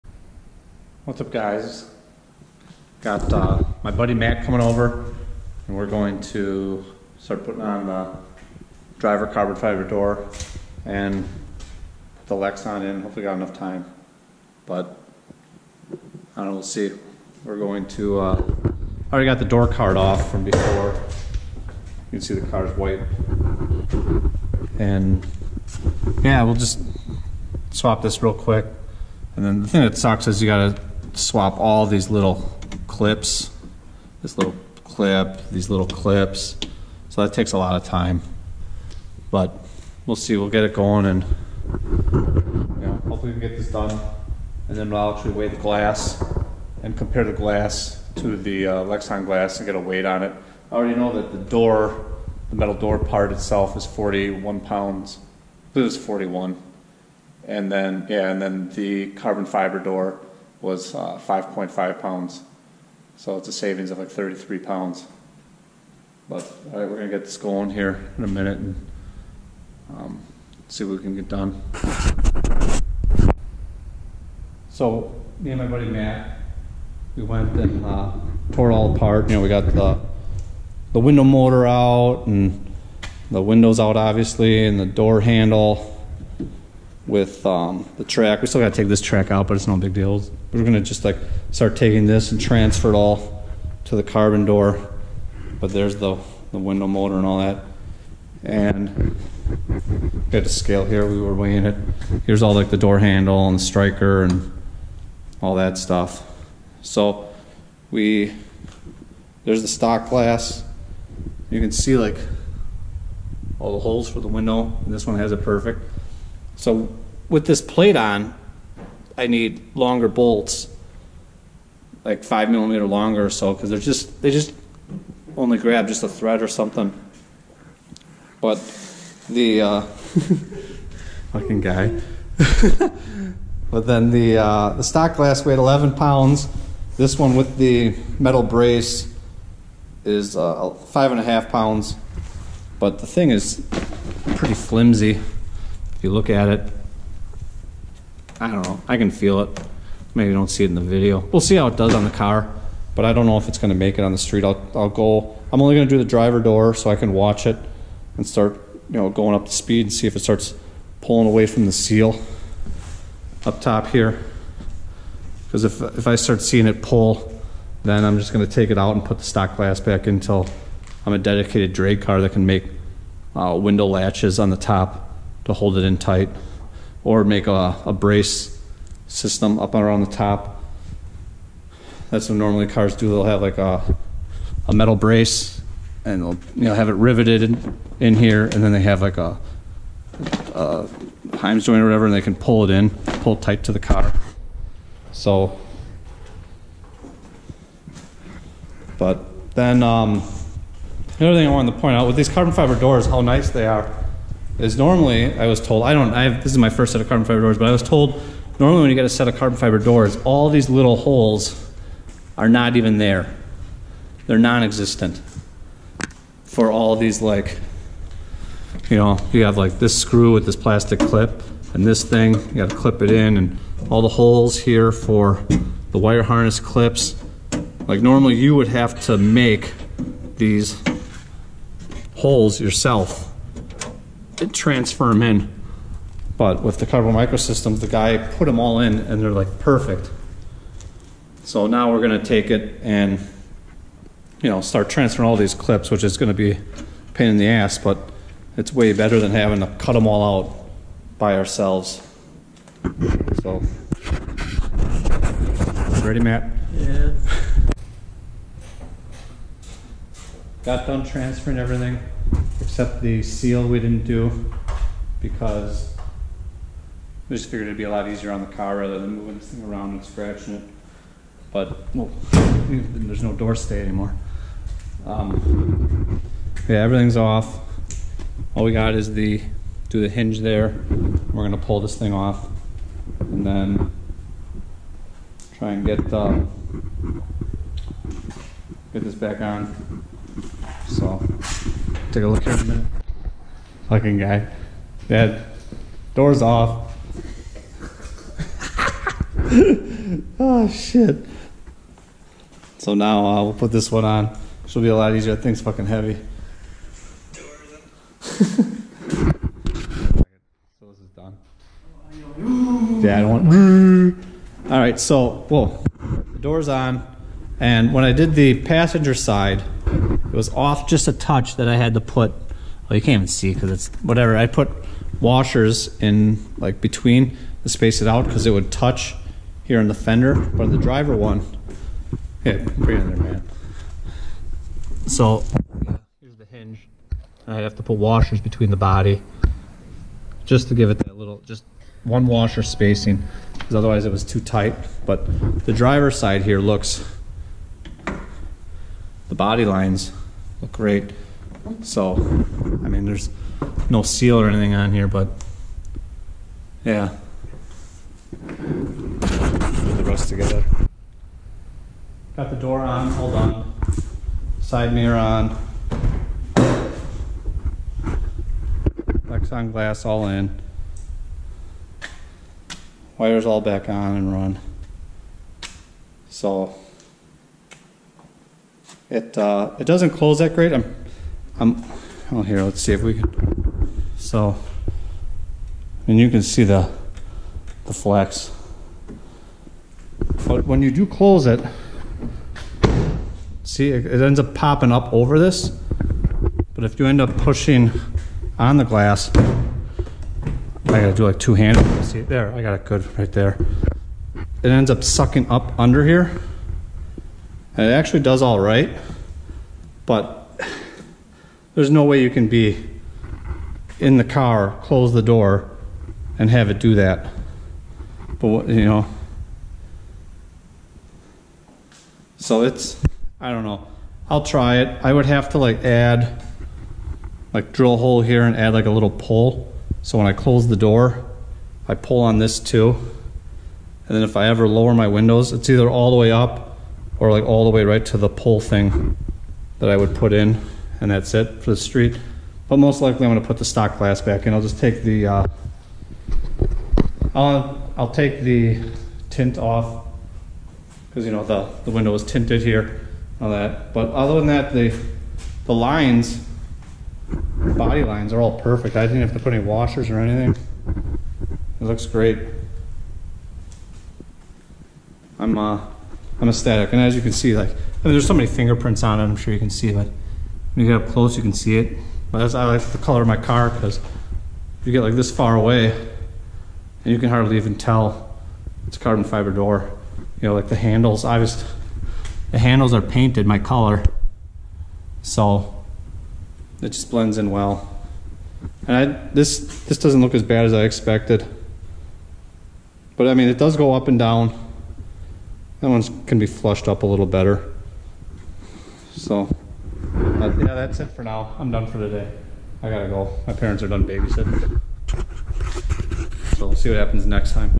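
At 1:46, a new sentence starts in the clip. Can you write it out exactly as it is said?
So we, there's the stock glass.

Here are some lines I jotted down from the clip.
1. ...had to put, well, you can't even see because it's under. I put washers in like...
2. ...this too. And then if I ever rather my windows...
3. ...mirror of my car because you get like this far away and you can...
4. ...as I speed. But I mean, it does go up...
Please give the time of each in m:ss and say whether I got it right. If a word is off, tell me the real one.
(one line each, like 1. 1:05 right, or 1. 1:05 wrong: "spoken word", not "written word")
1. 5:21 wrong: "whatever", not "under"
2. 7:12 wrong: "lower", not "rather"
3. 7:52 wrong: "color", not "mirror"
4. 8:10 wrong: "expected", not "speed".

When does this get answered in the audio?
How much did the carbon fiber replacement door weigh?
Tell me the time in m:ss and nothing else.
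1:01.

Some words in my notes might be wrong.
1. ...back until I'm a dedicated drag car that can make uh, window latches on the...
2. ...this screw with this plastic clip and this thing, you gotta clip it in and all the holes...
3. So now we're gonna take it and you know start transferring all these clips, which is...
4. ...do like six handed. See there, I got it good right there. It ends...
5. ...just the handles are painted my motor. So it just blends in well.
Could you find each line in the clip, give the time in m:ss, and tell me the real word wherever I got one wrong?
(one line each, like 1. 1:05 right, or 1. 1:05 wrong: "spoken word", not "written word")
1. 2:49 right
2. 3:39 right
3. 4:01 right
4. 6:41 wrong: "two", not "six"
5. 8:01 wrong: "color", not "motor".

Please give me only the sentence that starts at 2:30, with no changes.
Maybe don't see it in the video.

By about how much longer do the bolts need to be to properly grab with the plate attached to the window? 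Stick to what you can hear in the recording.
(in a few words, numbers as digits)
5 millimeters.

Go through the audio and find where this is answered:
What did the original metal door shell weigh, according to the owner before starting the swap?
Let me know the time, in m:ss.
0:53.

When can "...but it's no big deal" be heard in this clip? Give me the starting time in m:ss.
1:29.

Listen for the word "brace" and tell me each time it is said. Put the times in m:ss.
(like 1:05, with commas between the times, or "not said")
2:18, 2:57, 3:04.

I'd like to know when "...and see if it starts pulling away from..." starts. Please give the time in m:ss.
2:39.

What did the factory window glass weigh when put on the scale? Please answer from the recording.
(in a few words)
11 pounds.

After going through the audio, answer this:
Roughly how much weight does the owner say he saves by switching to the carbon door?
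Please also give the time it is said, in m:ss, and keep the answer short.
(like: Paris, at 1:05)
33 pounds, at 1:04.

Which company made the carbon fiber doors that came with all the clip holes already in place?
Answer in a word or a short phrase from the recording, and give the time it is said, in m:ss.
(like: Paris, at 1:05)
Carbon Microsystems, at 3:56.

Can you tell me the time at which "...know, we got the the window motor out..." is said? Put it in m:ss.
1:19.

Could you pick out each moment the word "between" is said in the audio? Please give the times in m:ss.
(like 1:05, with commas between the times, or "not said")
5:26, 5:38.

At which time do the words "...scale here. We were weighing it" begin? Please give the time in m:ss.
1:40.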